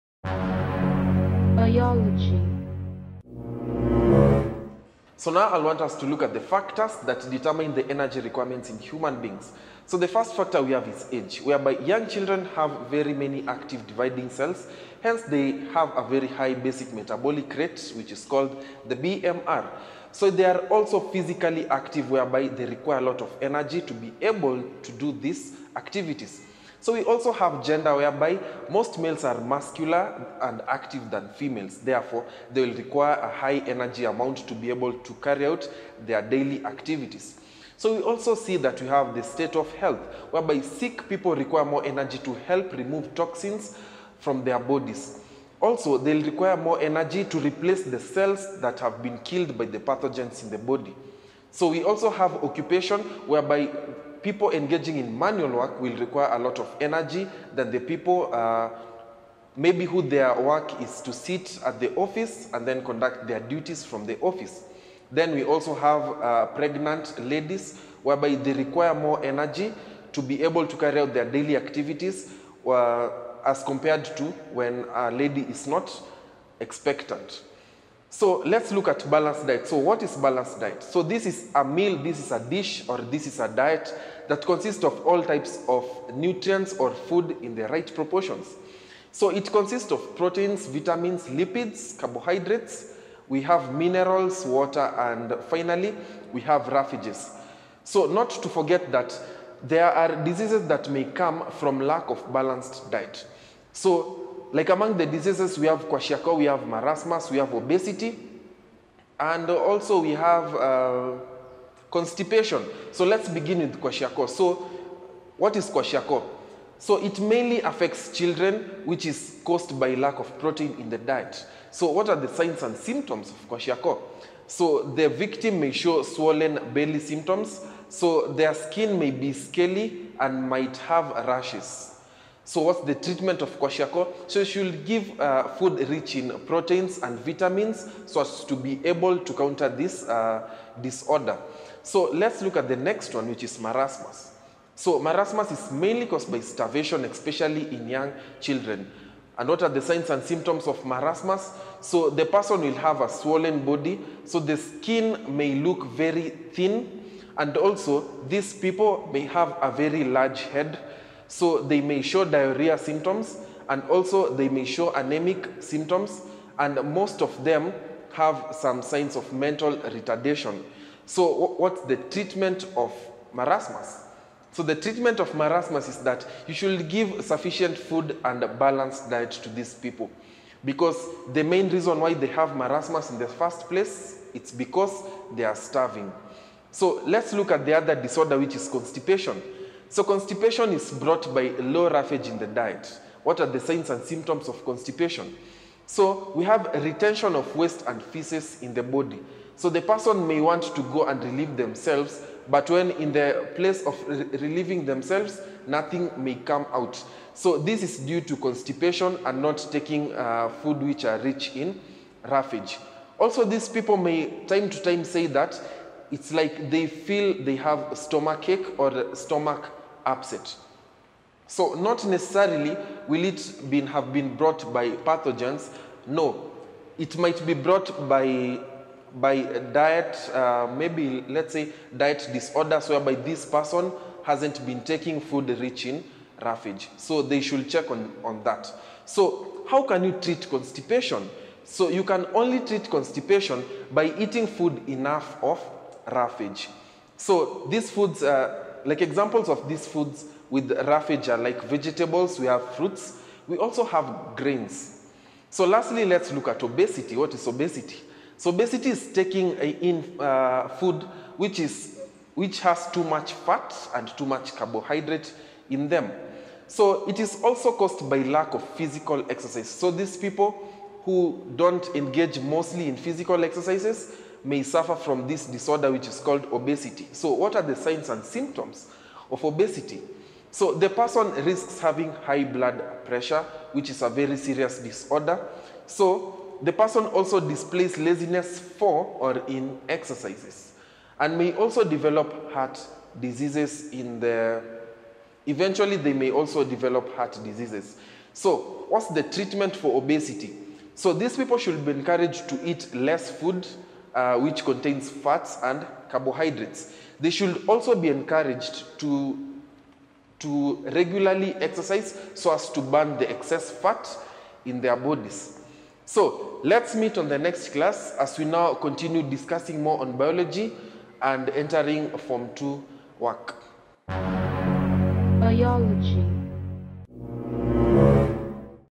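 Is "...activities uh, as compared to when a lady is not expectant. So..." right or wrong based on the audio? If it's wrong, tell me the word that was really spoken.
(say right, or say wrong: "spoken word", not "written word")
right.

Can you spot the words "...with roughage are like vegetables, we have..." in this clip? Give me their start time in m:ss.
4:10.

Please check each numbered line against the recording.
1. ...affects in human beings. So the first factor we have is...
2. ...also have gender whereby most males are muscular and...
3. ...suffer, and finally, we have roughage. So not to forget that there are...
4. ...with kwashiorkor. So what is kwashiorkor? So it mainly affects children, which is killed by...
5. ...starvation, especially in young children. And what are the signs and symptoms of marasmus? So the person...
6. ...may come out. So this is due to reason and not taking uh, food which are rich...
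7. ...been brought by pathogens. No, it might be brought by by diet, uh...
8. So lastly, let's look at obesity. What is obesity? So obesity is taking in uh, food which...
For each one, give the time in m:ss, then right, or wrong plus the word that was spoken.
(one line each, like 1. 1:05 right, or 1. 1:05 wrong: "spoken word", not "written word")
1. 0:08 wrong: "requirements", not "affects"
2. 0:27 right
3. 1:34 wrong: "water", not "suffer"
4. 1:53 wrong: "caused", not "killed"
5. 2:26 right
6. 3:26 wrong: "constipation", not "reason"
7. 3:44 right
8. 4:15 right.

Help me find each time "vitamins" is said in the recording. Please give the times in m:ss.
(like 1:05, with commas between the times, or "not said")
1:30, 2:17.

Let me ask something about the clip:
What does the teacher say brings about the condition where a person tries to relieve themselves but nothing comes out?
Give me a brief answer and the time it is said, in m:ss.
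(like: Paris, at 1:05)
Low roughage in the diet, at 3:11.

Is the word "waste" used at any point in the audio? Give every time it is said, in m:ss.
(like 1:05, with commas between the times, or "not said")
3:17.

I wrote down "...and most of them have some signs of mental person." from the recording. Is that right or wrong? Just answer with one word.
wrong.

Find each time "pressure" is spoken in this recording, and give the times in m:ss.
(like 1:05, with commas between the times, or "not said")
4:43.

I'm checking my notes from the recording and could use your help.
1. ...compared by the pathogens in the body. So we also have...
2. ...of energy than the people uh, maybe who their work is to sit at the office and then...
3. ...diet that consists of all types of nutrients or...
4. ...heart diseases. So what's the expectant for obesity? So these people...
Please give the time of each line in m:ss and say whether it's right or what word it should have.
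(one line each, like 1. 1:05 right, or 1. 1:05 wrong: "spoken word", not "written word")
1. 0:49 wrong: "killed", not "compared"
2. 0:56 right
3. 1:23 right
4. 4:57 wrong: "treatment", not "expectant".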